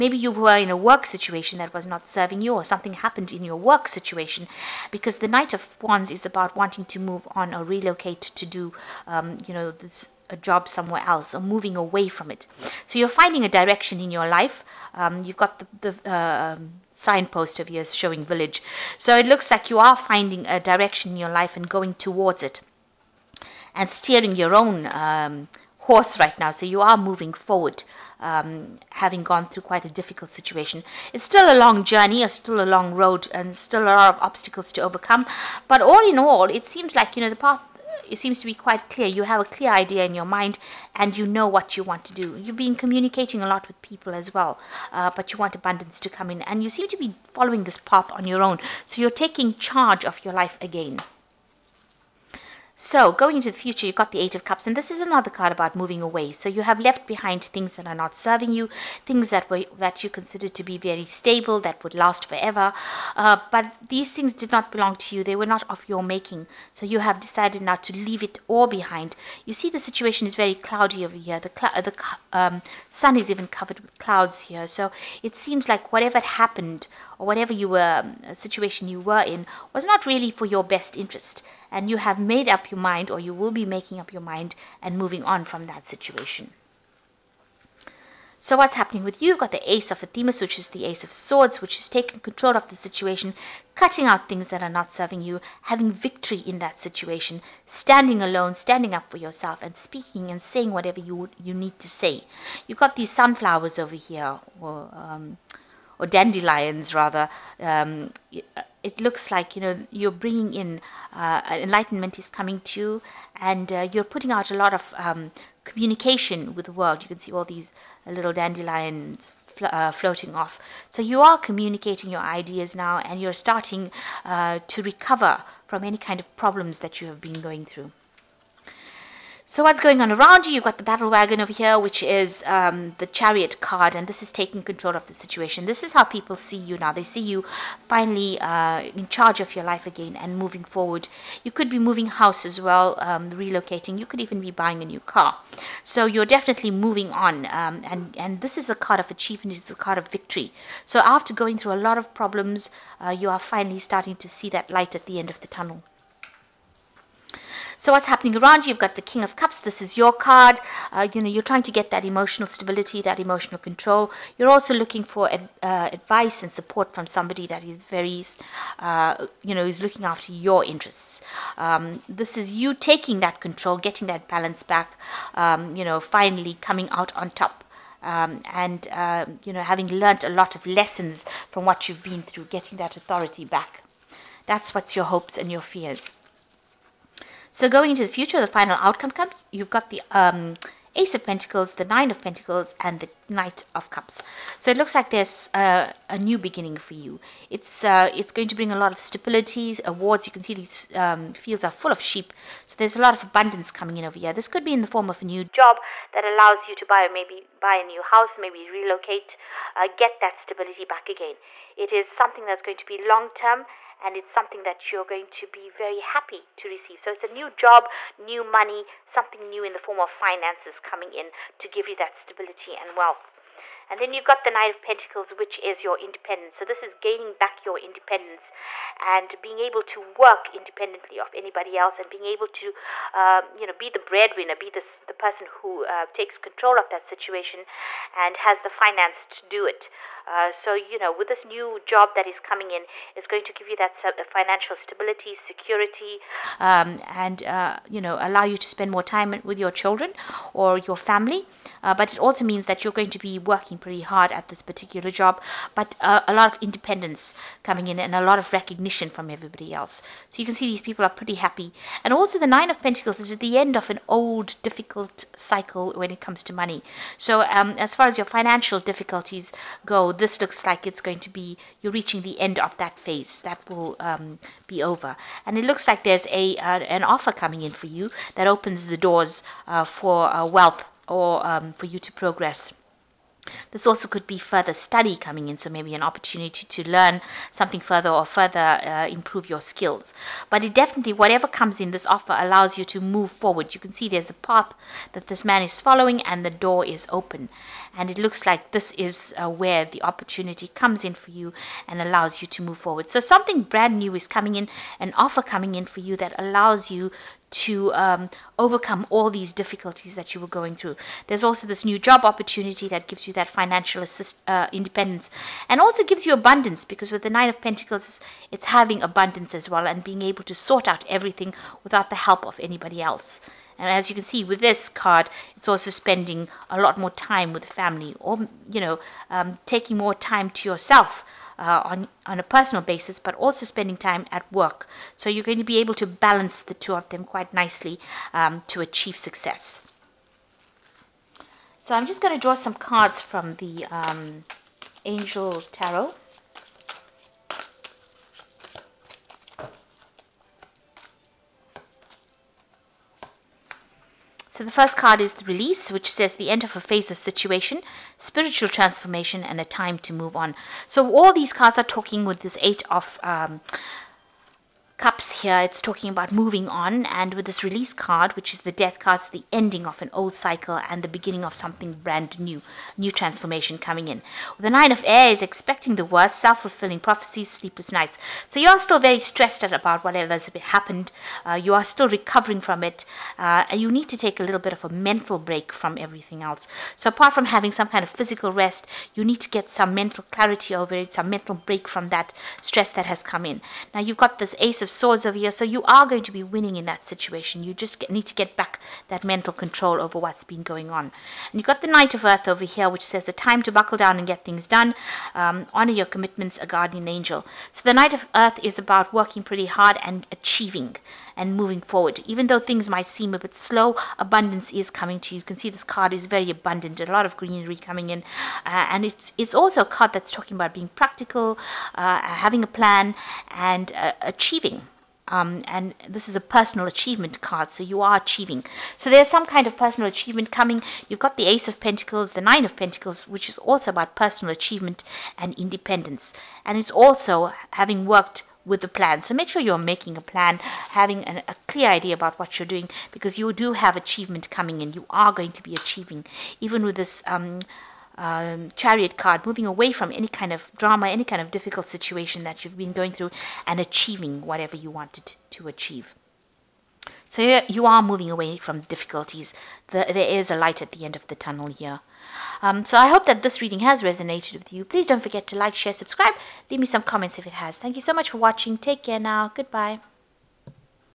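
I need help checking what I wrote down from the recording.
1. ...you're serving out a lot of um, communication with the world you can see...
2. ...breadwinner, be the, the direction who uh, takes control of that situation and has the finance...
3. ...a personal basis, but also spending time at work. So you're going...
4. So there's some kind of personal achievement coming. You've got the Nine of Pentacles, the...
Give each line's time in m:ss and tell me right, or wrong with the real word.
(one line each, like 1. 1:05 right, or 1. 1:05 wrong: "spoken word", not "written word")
1. 1:53 wrong: "putting", not "serving"
2. 3:53 wrong: "person", not "direction"
3. 5:32 right
4. 7:08 wrong: "Ace", not "Nine".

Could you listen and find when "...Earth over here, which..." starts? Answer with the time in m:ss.
6:42.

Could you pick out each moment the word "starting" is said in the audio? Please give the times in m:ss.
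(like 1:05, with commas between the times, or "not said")
2:03, 2:33.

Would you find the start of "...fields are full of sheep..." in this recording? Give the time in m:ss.
3:21.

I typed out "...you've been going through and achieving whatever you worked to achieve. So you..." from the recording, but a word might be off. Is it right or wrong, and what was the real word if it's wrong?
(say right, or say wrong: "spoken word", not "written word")
wrong: "wanted", not "worked".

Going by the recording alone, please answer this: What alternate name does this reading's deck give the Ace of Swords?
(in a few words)
Ace of Athames.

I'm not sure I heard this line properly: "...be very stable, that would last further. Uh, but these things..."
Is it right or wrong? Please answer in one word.
wrong.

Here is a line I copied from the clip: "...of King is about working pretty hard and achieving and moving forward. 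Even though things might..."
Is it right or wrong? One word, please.
wrong.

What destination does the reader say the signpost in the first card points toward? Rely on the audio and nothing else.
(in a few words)
village.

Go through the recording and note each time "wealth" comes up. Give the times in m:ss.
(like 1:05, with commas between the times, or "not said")
3:42, 4:40.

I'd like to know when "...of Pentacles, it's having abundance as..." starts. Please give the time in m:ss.
5:17.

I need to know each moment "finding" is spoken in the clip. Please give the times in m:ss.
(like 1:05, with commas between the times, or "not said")
0:13, 0:19.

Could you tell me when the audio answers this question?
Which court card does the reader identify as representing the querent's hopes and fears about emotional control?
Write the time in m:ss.
2:39.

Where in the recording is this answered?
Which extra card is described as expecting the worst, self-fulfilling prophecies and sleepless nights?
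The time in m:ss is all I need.
6:14.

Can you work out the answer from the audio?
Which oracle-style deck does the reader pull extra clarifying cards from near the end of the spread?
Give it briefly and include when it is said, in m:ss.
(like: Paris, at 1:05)
Angel Tarot, at 5:45.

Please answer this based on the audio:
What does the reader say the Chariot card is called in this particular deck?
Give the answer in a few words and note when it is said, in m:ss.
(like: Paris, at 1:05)
battle wagon, at 2:10.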